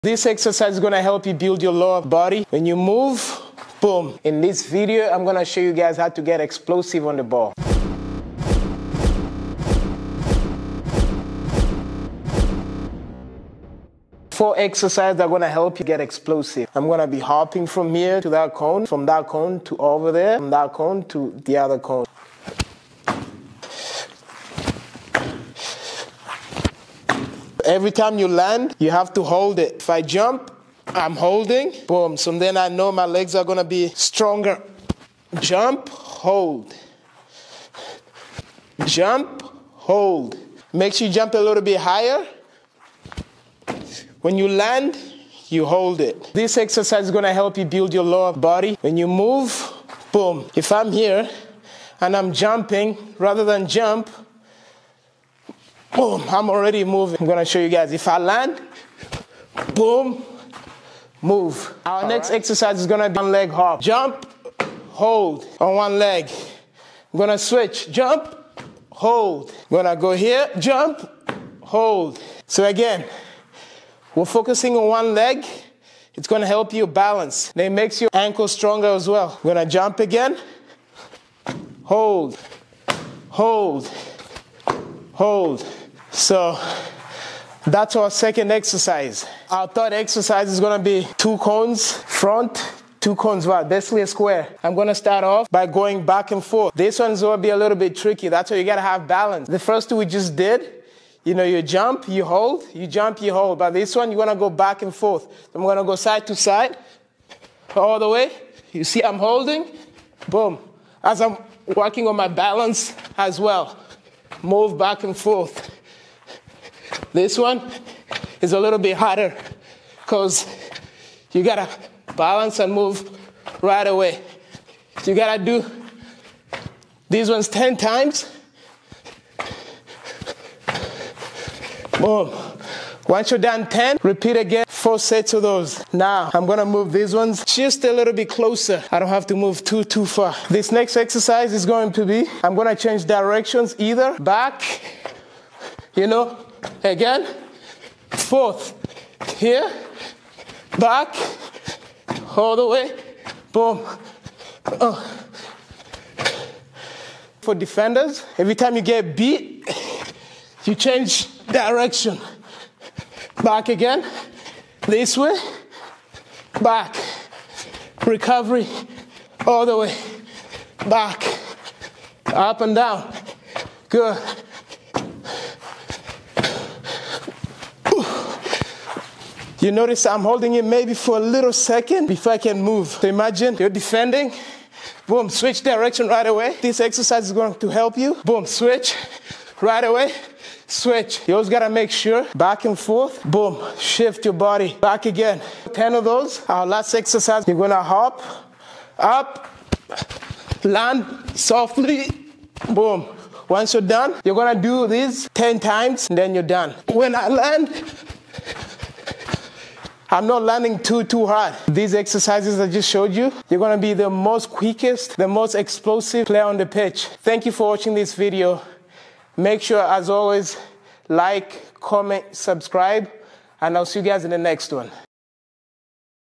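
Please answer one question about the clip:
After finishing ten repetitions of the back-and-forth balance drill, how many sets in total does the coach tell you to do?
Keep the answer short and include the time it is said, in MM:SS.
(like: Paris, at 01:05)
4 sets, at 02:14.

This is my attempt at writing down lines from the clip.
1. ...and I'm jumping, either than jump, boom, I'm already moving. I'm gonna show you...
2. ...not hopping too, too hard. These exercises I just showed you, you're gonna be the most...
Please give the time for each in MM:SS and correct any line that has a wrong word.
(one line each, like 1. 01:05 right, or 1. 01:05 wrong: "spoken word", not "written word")
1. 00:52 wrong: "rather", not "either"
2. 03:30 wrong: "landing", not "hopping".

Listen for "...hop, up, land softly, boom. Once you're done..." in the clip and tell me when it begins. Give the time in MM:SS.
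03:17.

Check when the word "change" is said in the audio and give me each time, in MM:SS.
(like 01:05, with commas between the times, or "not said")
02:22, 02:40.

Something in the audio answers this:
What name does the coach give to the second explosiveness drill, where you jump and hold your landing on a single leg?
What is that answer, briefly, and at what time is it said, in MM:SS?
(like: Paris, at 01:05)
One leg hop, at 01:03.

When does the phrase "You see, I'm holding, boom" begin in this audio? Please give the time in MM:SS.
01:48.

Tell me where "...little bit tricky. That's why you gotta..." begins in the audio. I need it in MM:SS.
01:37.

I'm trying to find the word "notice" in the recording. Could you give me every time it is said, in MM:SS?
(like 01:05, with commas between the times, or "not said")
02:59.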